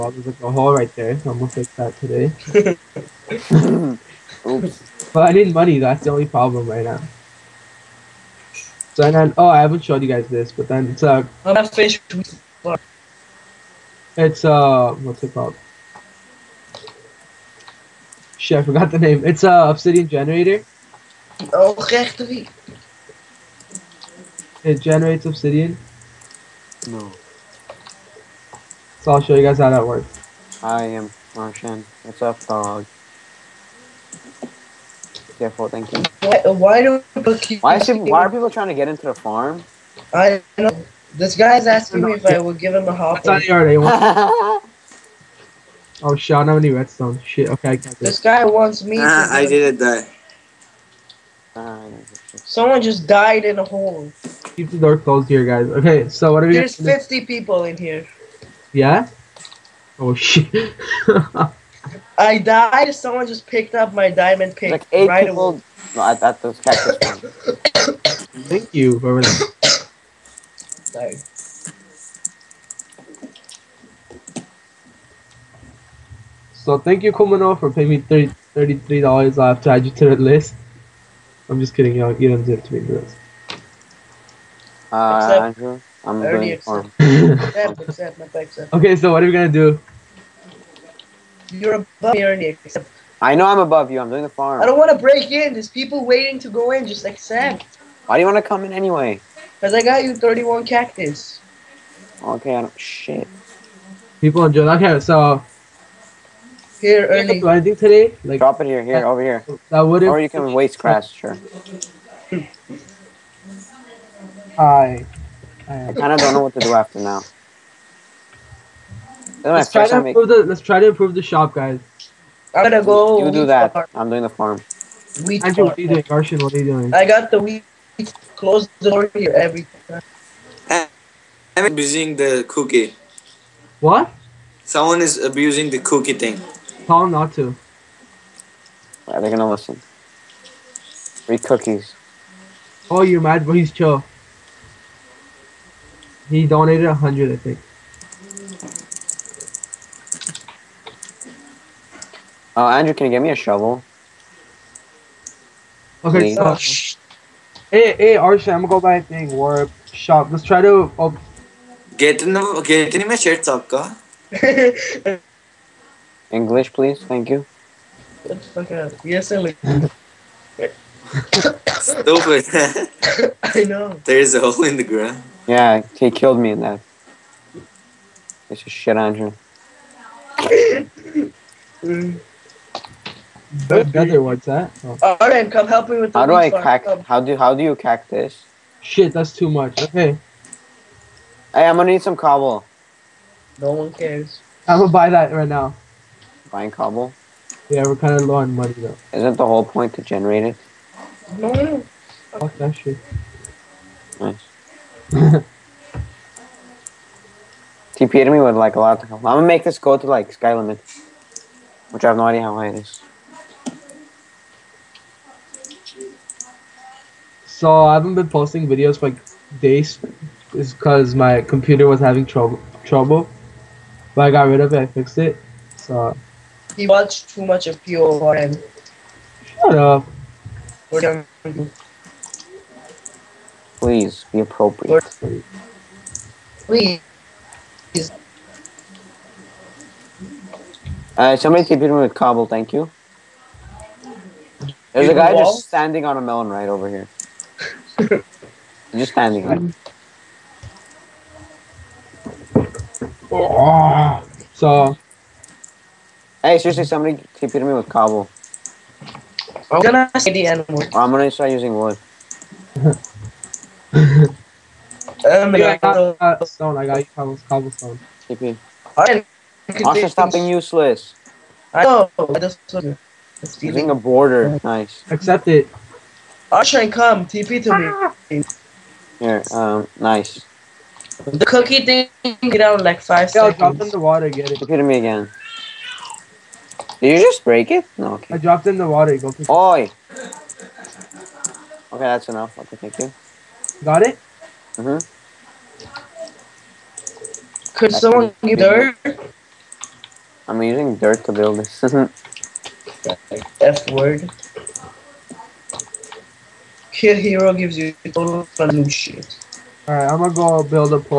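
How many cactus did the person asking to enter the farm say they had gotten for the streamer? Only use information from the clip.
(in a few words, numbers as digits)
31.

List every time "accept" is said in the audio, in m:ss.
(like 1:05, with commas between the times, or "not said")
1:26, 1:37, 4:35.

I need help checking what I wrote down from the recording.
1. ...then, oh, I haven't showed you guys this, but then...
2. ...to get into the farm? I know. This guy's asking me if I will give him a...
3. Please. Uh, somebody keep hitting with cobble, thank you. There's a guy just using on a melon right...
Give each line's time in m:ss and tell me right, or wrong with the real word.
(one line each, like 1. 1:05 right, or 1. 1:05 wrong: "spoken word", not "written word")
1. 0:09 right
2. 0:38 right
3. 3:56 wrong: "standing", not "using".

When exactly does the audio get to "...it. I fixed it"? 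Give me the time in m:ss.
3:44.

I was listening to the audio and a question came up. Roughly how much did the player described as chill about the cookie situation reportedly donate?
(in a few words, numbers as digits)
100.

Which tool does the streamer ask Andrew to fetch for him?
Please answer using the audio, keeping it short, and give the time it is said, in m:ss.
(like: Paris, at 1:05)
Shovel, at 2:33.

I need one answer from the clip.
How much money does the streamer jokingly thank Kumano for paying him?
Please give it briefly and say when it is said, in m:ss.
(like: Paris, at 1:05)
$33, at 1:18.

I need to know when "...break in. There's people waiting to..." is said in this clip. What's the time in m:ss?
1:34.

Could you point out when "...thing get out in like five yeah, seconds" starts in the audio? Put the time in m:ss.
4:41.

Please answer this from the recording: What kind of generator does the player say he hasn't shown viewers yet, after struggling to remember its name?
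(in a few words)
Obsidian generator.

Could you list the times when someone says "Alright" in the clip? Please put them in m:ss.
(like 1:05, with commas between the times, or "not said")
3:05, 4:28, 5:09.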